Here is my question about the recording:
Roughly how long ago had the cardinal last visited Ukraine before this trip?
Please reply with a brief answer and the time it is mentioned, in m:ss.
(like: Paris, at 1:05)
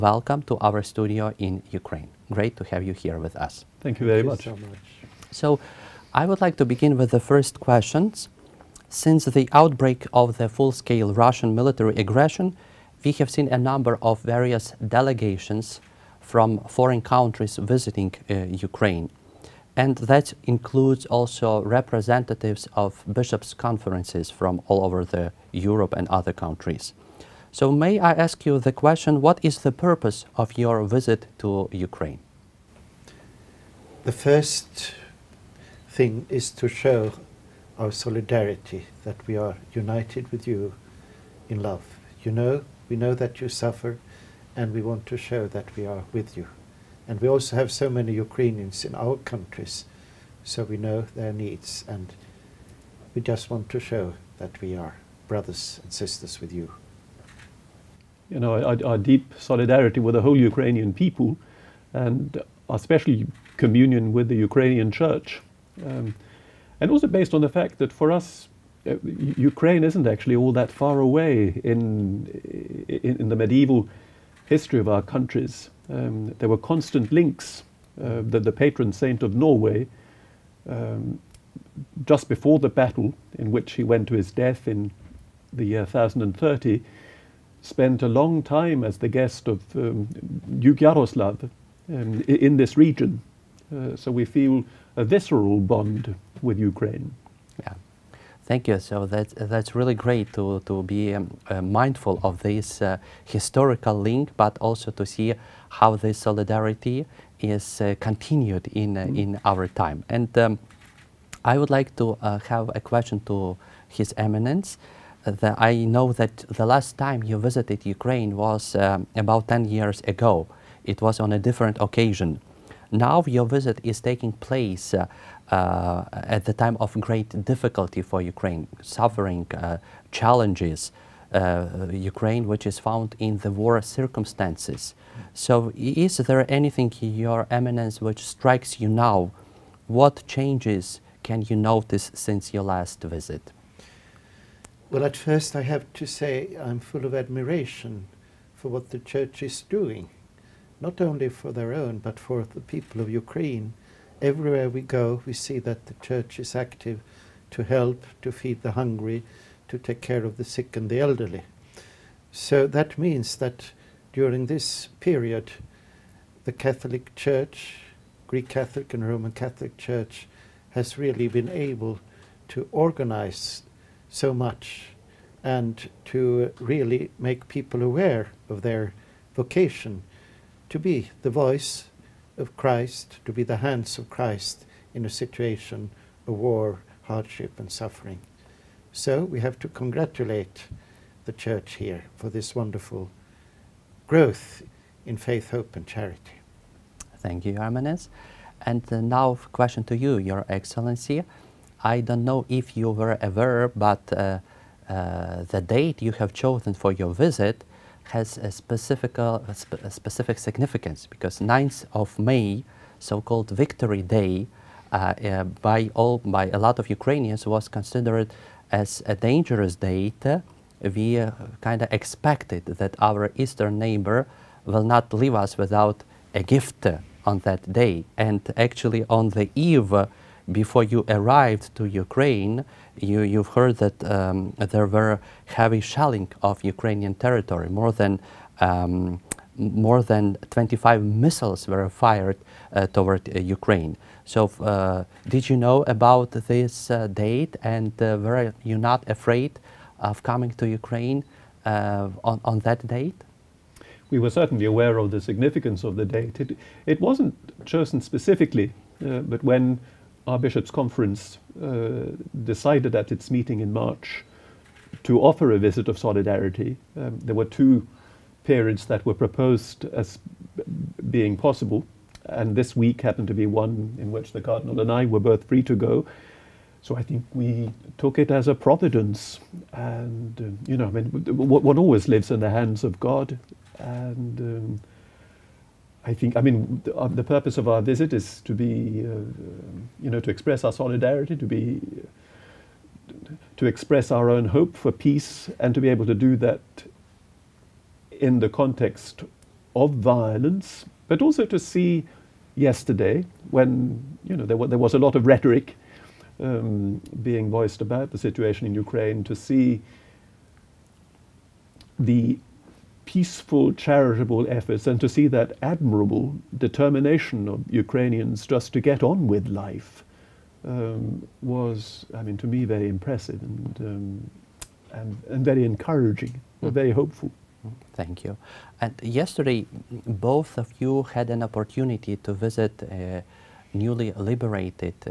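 10 years, at 1:59.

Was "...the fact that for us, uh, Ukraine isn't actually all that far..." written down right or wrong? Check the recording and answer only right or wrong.
right.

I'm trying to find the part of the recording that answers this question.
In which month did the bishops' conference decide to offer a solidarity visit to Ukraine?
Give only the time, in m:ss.
4:23.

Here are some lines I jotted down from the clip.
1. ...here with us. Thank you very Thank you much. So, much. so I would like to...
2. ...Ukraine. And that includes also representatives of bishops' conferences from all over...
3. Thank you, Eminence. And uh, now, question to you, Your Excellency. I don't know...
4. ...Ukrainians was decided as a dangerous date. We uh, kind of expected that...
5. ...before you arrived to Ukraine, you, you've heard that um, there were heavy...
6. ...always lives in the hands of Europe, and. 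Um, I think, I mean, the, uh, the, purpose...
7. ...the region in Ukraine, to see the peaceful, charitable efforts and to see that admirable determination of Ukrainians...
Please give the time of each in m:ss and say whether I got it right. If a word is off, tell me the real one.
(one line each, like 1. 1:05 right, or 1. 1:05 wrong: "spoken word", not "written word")
1. 0:02 right
2. 0:18 right
3. 3:17 right
4. 3:36 wrong: "considered", not "decided"
5. 3:50 right
6. 4:41 wrong: "God", not "Europe"
7. 5:08 wrong: "situation", not "region".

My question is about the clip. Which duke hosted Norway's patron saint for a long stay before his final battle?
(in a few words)
Duke Yaroslav.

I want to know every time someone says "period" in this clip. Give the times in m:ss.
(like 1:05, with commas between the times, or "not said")
2:44, 4:28.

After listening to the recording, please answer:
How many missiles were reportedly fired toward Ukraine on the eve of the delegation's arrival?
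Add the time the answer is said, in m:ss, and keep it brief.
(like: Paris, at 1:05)
More than 25, at 3:59.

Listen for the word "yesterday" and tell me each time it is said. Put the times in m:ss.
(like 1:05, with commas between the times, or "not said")
5:02, 5:29.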